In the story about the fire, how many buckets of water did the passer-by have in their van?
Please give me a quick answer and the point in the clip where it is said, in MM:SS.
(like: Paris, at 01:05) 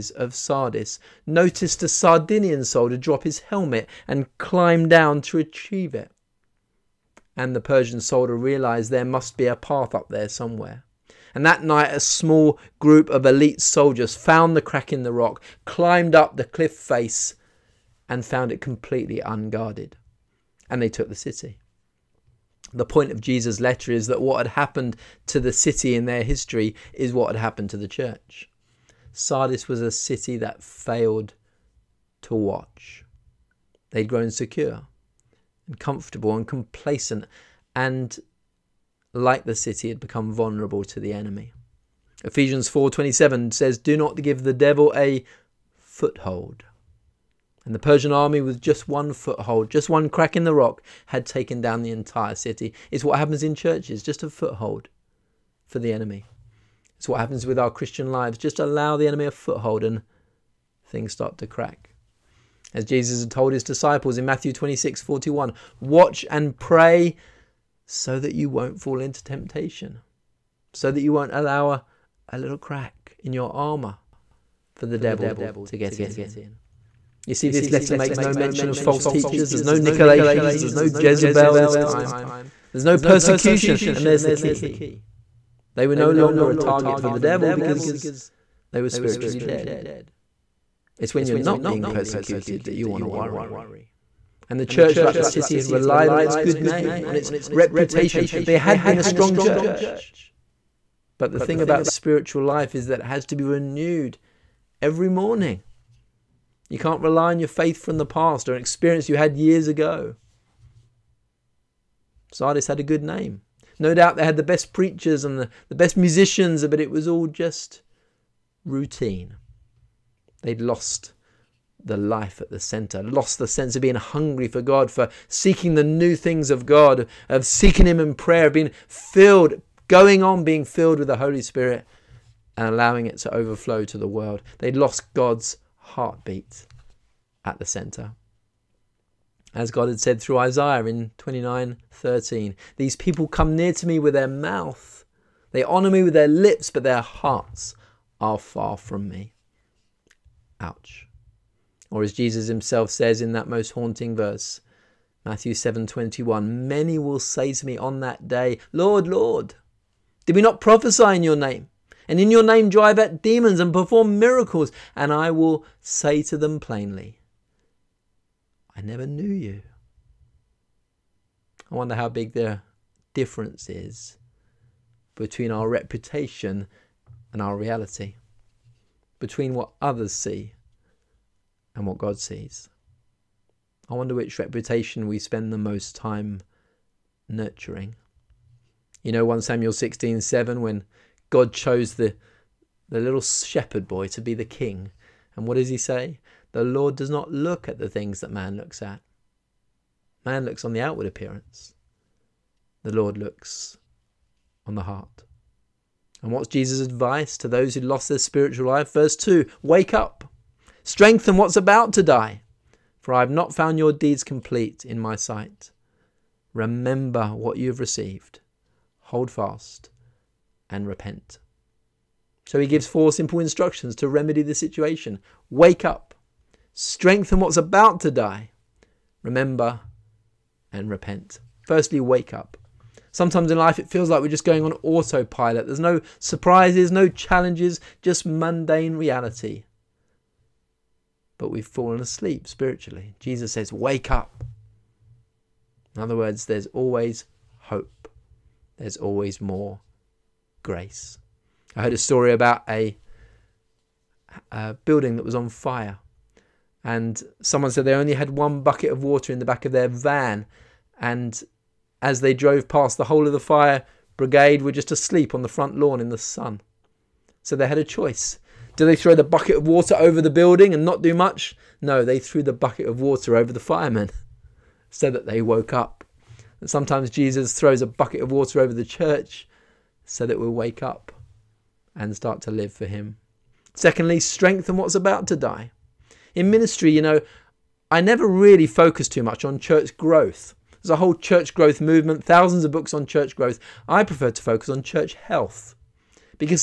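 1, at 04:18.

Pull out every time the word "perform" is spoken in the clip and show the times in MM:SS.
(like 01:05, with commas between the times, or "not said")
02:43.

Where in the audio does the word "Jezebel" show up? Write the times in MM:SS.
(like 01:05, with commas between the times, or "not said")
01:20.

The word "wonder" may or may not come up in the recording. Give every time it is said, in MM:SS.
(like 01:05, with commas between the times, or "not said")
02:51, 03:03.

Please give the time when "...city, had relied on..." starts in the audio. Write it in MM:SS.
01:35.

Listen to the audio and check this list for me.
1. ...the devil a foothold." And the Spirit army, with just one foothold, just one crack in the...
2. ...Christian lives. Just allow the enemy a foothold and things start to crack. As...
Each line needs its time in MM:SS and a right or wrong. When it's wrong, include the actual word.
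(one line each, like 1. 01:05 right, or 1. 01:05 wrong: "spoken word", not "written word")
1. 00:44 wrong: "Persian", not "Spirit"
2. 00:57 right.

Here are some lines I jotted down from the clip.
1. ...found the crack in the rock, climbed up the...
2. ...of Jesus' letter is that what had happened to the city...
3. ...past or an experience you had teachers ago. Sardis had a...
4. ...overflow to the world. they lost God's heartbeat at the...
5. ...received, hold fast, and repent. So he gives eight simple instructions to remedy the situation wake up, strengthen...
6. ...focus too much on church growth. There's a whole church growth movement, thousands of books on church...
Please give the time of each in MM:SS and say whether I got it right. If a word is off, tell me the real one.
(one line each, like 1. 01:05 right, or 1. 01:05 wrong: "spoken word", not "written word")
1. 00:14 right
2. 00:23 right
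3. 01:48 wrong: "years", not "teachers"
4. 02:13 right
5. 03:37 wrong: "four", not "eight"
6. 04:48 right.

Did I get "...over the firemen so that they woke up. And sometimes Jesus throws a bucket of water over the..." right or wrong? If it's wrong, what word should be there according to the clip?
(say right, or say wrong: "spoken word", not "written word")
right.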